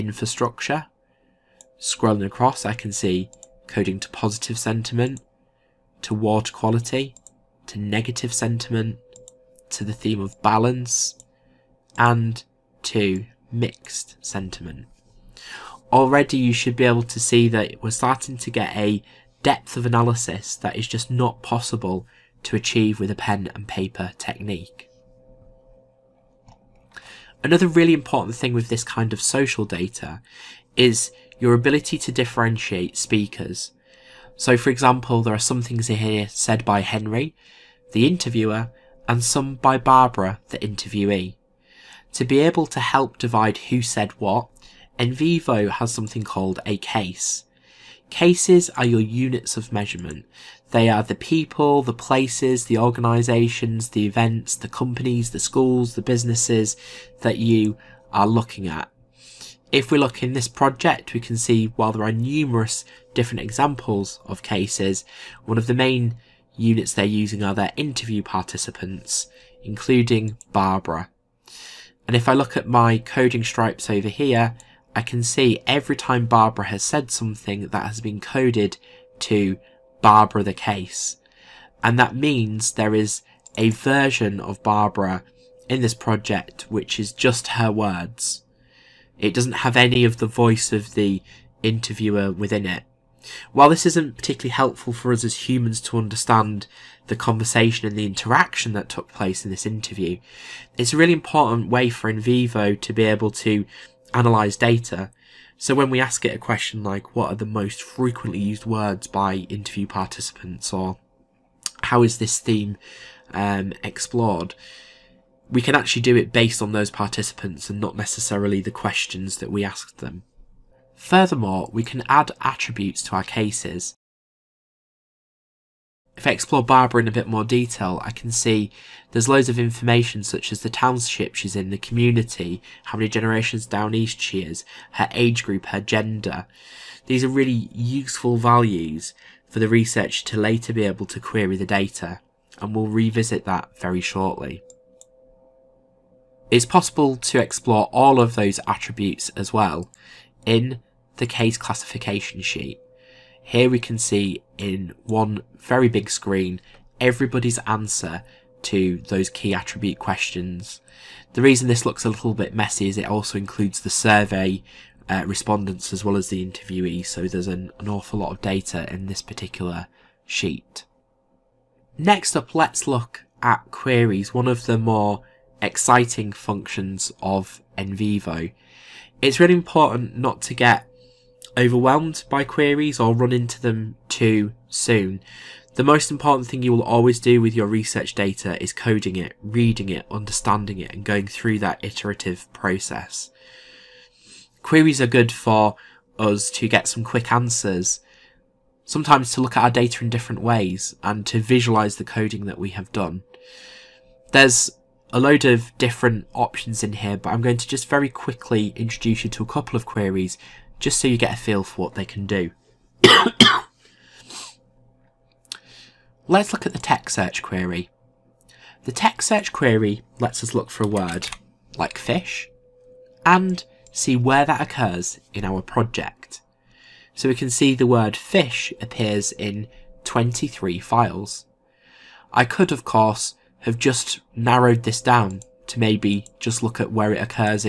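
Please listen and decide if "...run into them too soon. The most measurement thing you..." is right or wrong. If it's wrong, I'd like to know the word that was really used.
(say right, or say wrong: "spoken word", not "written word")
wrong: "important", not "measurement".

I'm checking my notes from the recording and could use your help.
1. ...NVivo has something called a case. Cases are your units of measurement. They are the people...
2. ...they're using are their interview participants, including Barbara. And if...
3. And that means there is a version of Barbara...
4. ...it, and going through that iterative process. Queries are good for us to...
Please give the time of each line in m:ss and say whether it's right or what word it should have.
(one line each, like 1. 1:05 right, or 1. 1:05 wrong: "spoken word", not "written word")
1. 0:44 right
2. 1:06 right
3. 1:21 right
4. 3:10 right.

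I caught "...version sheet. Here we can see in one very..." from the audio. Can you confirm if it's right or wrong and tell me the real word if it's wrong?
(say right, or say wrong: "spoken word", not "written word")
wrong: "classification", not "version".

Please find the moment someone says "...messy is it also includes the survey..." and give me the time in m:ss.
2:42.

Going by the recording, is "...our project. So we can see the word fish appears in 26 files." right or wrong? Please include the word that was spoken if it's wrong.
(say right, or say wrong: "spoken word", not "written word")
wrong: "23", not "26".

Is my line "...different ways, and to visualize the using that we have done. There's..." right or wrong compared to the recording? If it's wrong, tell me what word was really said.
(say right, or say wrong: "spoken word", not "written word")
wrong: "coding", not "using".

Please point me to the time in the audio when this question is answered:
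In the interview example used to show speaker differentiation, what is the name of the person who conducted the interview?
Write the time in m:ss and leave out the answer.
0:36.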